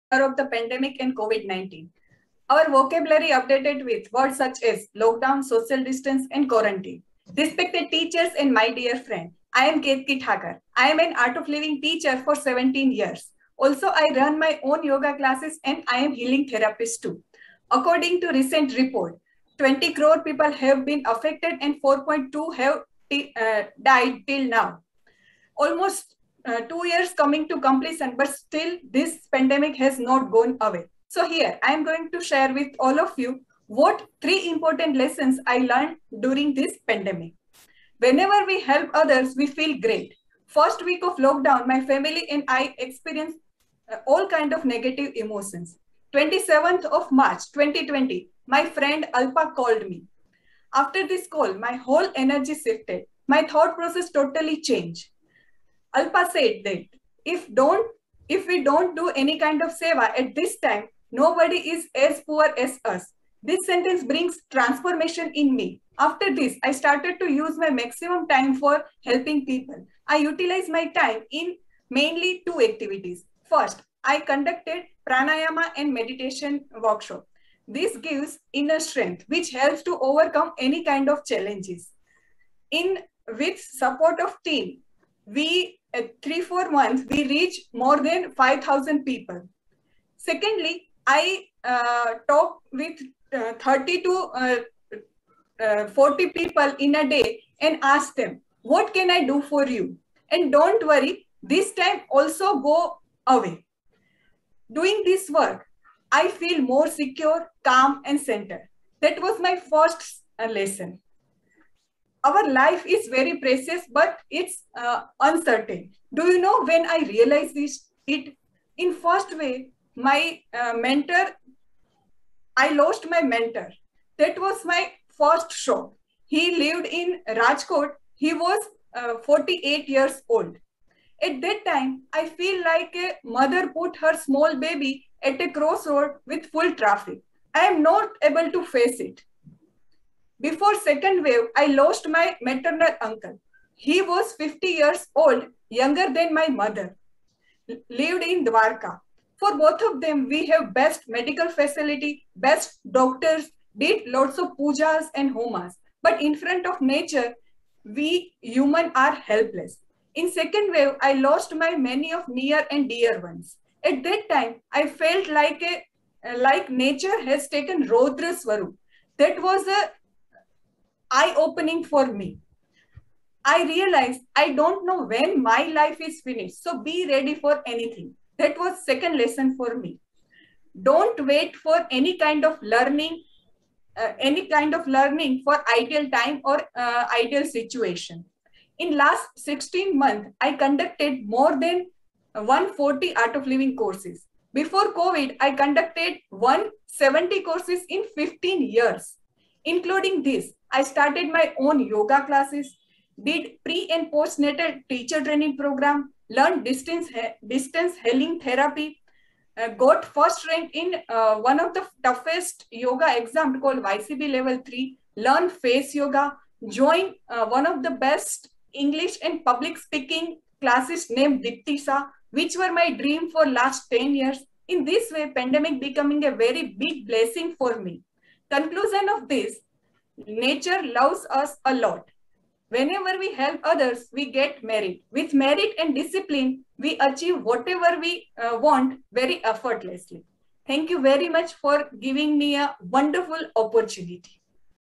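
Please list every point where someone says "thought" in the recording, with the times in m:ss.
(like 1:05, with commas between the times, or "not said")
0:53.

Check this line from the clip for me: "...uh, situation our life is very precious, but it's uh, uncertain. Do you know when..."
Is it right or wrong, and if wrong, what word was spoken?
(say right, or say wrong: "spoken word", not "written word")
wrong: "lesson", not "situation".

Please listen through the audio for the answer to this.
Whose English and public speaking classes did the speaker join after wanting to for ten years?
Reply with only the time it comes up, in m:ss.
3:41.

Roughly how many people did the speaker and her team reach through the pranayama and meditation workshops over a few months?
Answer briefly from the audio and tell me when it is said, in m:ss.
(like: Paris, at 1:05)
5000, at 1:27.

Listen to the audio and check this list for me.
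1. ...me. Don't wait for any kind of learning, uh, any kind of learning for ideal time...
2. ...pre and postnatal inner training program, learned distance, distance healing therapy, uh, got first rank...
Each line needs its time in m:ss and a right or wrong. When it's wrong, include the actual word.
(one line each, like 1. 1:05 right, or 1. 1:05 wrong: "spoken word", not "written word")
1. 2:59 right
2. 3:23 wrong: "teacher", not "inner".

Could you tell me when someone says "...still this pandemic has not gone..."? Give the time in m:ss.
0:28.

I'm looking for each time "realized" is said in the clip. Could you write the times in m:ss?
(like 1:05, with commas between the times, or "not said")
1:57, 2:53.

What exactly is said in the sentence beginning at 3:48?
Conclusion of this, nature loves us a lot.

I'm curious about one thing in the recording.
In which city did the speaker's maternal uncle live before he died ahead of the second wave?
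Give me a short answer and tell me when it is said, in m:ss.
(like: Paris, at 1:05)
Dwarka, at 2:27.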